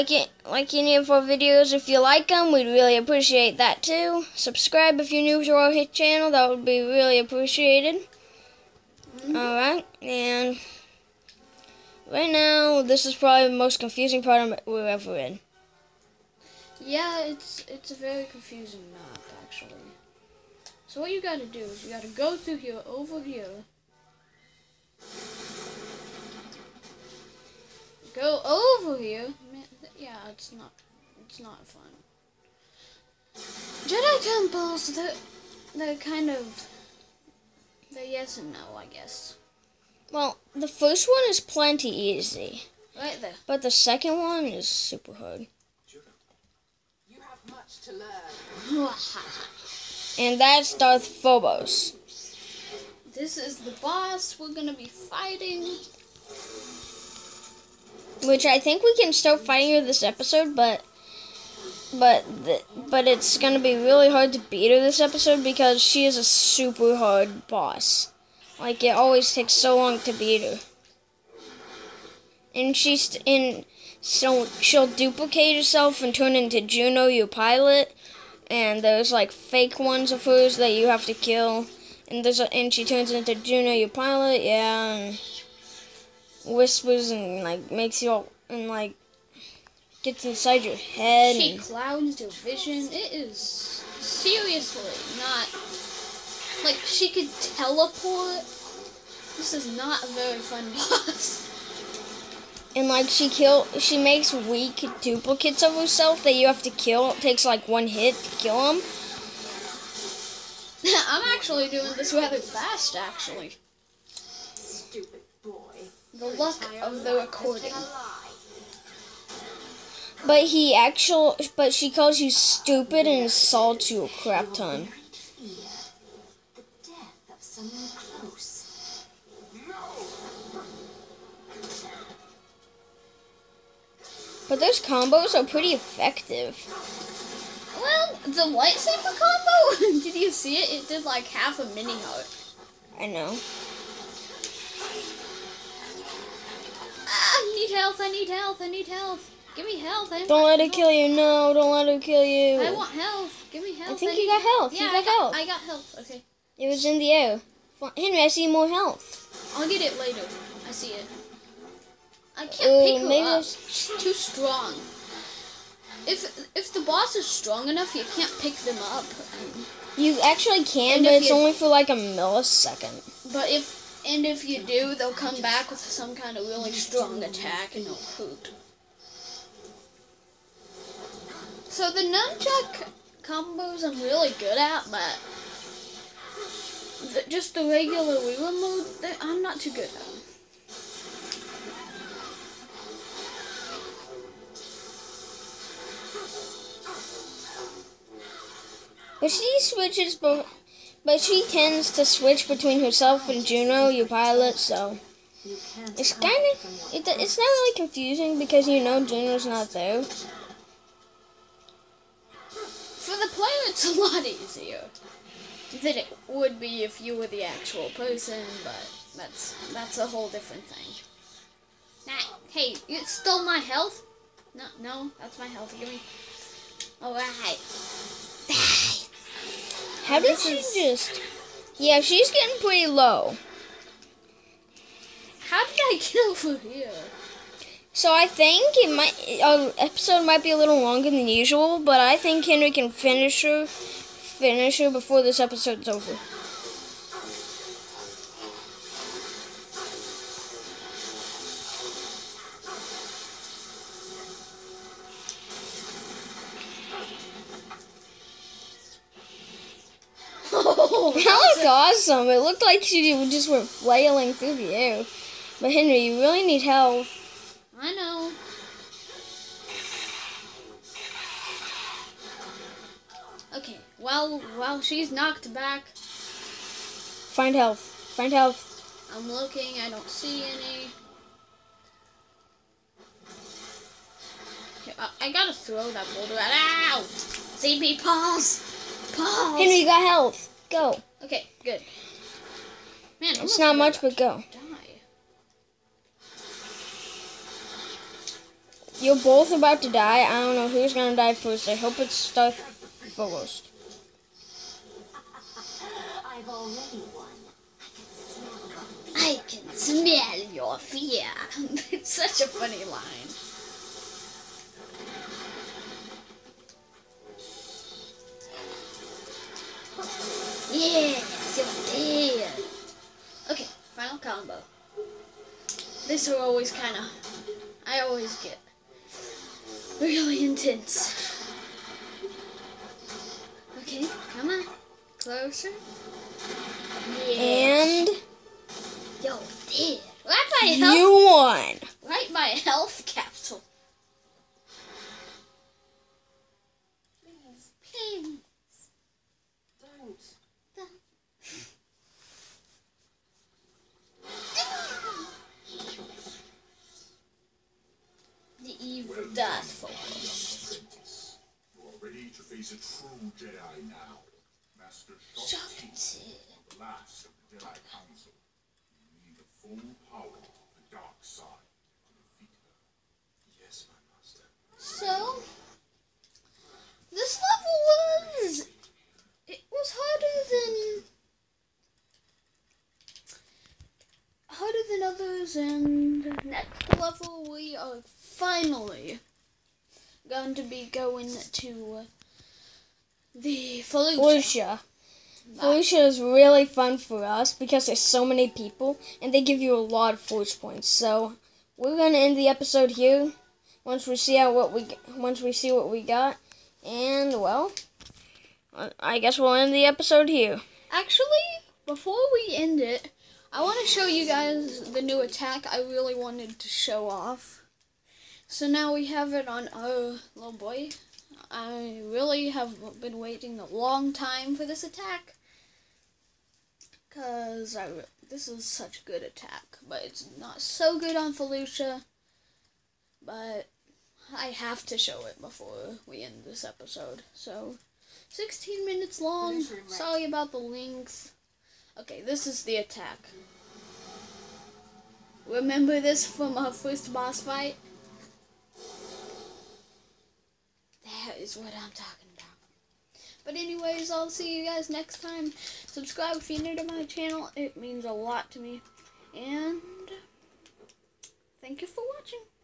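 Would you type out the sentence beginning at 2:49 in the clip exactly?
You actually can, and but it's you, only for like a millisecond.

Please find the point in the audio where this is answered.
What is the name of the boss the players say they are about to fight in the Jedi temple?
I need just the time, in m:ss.
0:50.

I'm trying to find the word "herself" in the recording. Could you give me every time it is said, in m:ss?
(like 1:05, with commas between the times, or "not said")
1:15, 1:45, 3:22.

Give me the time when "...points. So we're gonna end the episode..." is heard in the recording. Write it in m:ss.
6:40.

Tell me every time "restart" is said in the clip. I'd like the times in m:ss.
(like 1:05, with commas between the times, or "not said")
not said.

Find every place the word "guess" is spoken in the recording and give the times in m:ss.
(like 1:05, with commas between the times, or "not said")
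0:38, 6:49.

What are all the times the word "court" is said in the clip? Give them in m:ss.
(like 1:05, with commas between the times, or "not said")
not said.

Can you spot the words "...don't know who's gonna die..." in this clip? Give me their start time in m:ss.
5:00.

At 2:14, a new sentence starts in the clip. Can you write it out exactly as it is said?
But those combos are pretty effective.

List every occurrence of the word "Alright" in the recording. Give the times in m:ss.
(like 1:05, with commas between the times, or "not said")
0:09, 3:47.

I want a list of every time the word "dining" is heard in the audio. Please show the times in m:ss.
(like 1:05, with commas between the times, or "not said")
not said.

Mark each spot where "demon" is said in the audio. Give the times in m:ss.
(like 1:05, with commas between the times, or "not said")
not said.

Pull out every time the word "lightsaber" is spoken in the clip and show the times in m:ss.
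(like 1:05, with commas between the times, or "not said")
2:18.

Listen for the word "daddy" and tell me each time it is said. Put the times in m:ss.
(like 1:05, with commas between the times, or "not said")
not said.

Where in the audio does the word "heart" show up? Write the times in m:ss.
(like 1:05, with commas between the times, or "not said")
2:21.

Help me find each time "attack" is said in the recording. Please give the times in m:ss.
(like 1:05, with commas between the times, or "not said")
2:57, 6:55, 7:04, 7:09, 7:22.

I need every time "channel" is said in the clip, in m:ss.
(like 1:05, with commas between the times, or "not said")
0:05, 7:37.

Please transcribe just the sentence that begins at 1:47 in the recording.
It takes like one hit to kill them.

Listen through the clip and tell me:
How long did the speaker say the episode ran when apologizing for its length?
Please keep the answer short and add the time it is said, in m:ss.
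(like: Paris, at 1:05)
16 minutes, at 7:18.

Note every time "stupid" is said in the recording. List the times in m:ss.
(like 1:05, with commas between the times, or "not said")
1:54, 2:02.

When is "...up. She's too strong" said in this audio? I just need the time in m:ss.
2:43.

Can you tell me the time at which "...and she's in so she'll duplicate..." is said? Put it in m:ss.
1:12.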